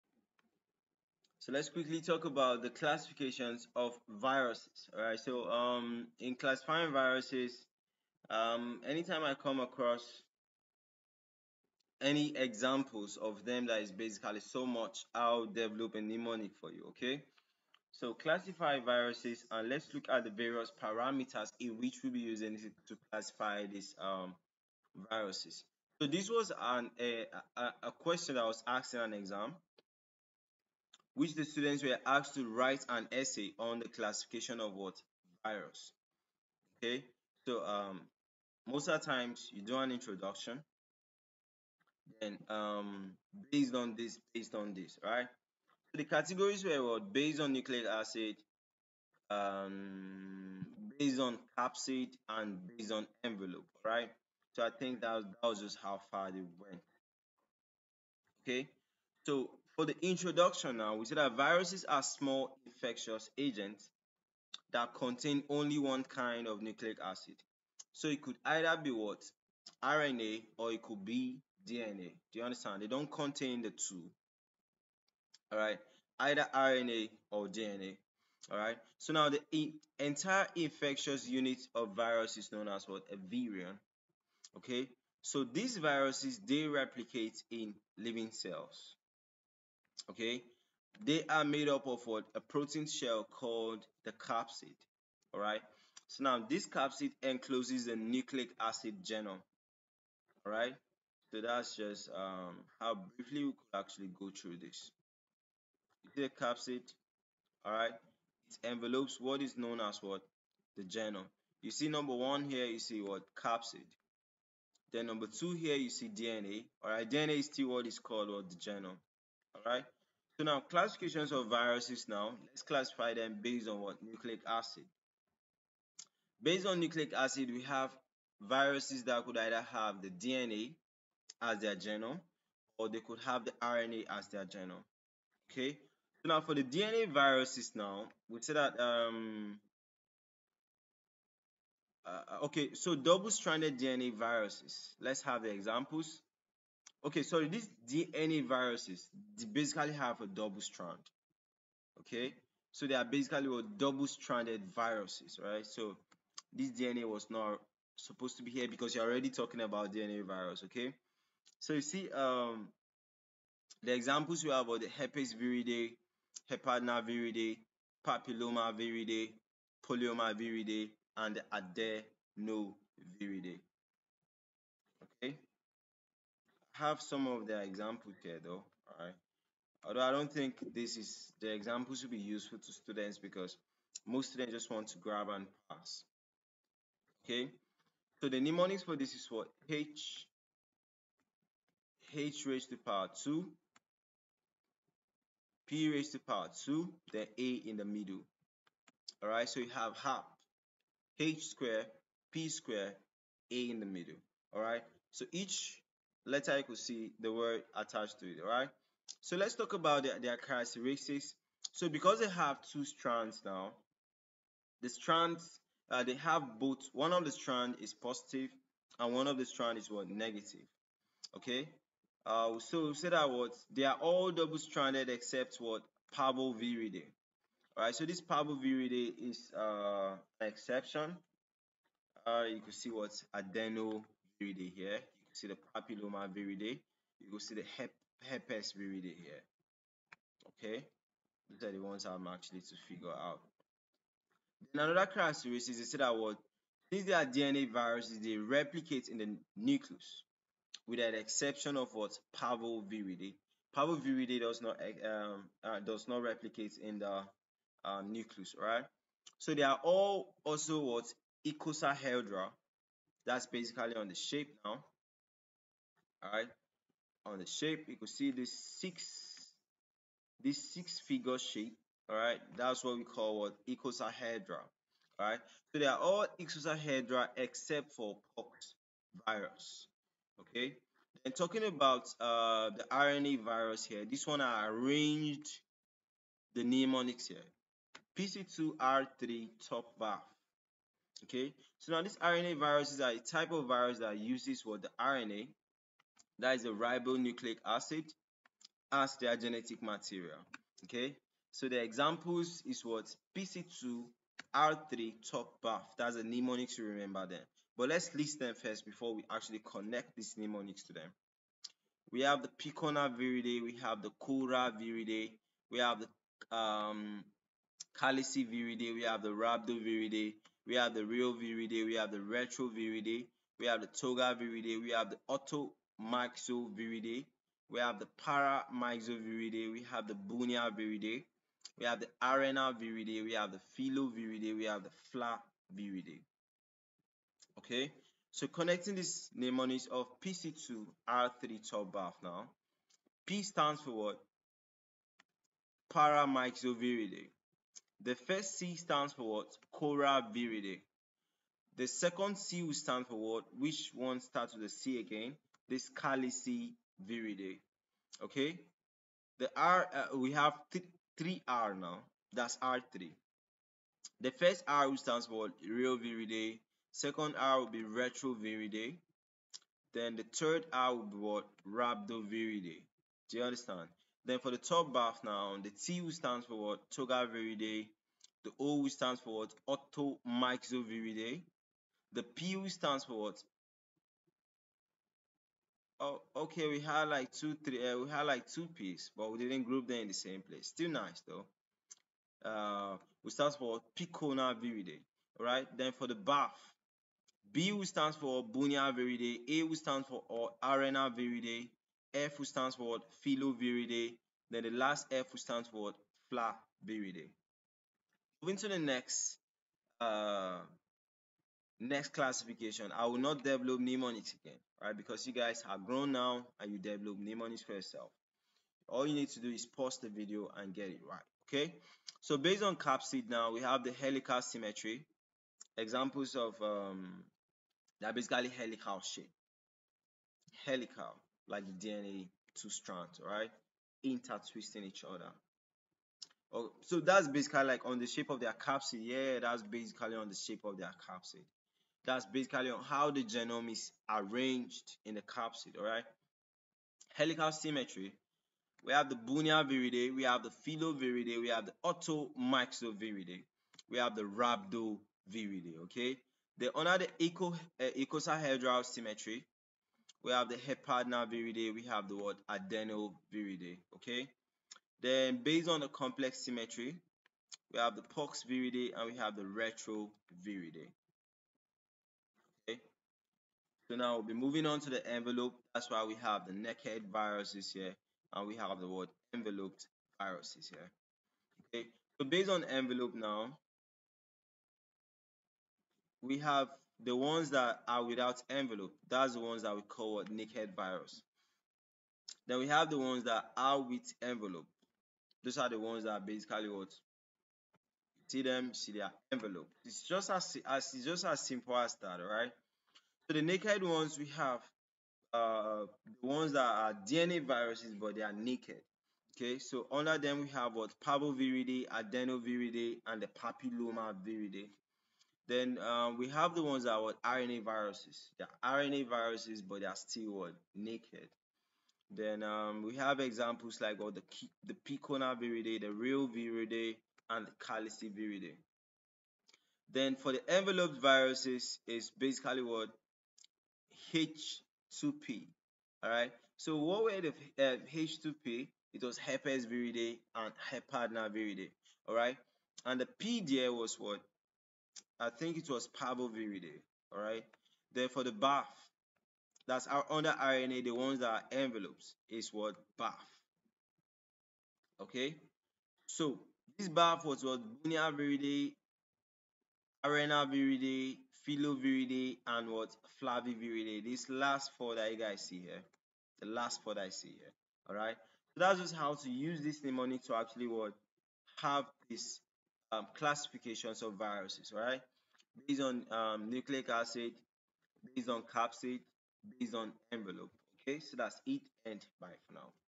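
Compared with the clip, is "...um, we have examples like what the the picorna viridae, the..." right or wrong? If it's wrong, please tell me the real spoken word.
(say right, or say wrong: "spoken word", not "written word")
right.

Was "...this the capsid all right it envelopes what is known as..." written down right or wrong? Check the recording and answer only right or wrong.
right.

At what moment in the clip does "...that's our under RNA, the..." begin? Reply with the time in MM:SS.
09:09.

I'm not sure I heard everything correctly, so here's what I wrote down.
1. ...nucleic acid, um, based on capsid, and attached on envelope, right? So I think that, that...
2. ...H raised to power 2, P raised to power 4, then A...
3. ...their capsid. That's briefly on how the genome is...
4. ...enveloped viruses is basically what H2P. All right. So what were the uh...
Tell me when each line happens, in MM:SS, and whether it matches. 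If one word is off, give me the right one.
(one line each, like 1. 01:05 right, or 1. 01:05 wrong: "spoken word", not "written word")
1. 00:47 wrong: "based", not "attached"
2. 03:12 wrong: "2", not "4"
3. 07:20 wrong: "basically", not "briefly"
4. 08:50 right.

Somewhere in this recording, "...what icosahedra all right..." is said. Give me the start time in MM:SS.
04:33.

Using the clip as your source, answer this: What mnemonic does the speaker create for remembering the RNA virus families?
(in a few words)
PC2R3 top bar.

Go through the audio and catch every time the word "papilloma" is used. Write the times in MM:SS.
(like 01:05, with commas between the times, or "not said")
02:48, 03:55, 08:33.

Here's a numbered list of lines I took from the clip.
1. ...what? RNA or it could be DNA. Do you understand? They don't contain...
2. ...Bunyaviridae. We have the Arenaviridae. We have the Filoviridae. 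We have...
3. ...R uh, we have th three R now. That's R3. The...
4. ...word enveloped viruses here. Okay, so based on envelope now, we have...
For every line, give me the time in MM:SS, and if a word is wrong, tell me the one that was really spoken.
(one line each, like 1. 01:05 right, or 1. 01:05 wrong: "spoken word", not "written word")
1. 01:08 right
2. 05:30 right
3. 05:59 right
4. 07:58 right.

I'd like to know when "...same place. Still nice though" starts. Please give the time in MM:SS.
06:30.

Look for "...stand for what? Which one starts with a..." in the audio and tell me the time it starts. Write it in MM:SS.
05:52.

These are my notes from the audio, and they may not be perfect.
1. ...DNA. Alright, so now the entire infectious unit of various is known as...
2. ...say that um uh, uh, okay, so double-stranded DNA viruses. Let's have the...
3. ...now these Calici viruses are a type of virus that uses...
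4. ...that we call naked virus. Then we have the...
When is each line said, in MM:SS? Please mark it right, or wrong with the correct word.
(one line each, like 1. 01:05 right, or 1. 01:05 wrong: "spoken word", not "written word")
1. 01:17 wrong: "virus", not "various"
2. 02:18 right
3. 04:51 wrong: "RNA", not "Calici"
4. 08:09 right.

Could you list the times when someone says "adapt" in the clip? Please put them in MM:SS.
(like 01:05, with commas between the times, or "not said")
not said.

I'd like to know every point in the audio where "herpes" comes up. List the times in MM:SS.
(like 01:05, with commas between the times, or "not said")
02:44, 03:58, 08:59.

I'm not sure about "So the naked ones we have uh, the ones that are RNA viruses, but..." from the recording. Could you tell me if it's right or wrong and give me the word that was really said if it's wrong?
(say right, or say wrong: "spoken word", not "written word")
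wrong: "DNA", not "RNA".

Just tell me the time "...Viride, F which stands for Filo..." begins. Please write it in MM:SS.
06:41.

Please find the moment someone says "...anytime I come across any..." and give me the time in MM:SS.
00:08.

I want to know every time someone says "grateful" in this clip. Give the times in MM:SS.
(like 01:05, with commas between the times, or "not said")
not said.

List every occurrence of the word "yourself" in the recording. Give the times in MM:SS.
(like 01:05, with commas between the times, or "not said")
06:57.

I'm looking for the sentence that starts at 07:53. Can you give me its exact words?
So now we'll be moving on to the envelope.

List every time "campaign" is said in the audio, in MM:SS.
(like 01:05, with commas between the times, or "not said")
not said.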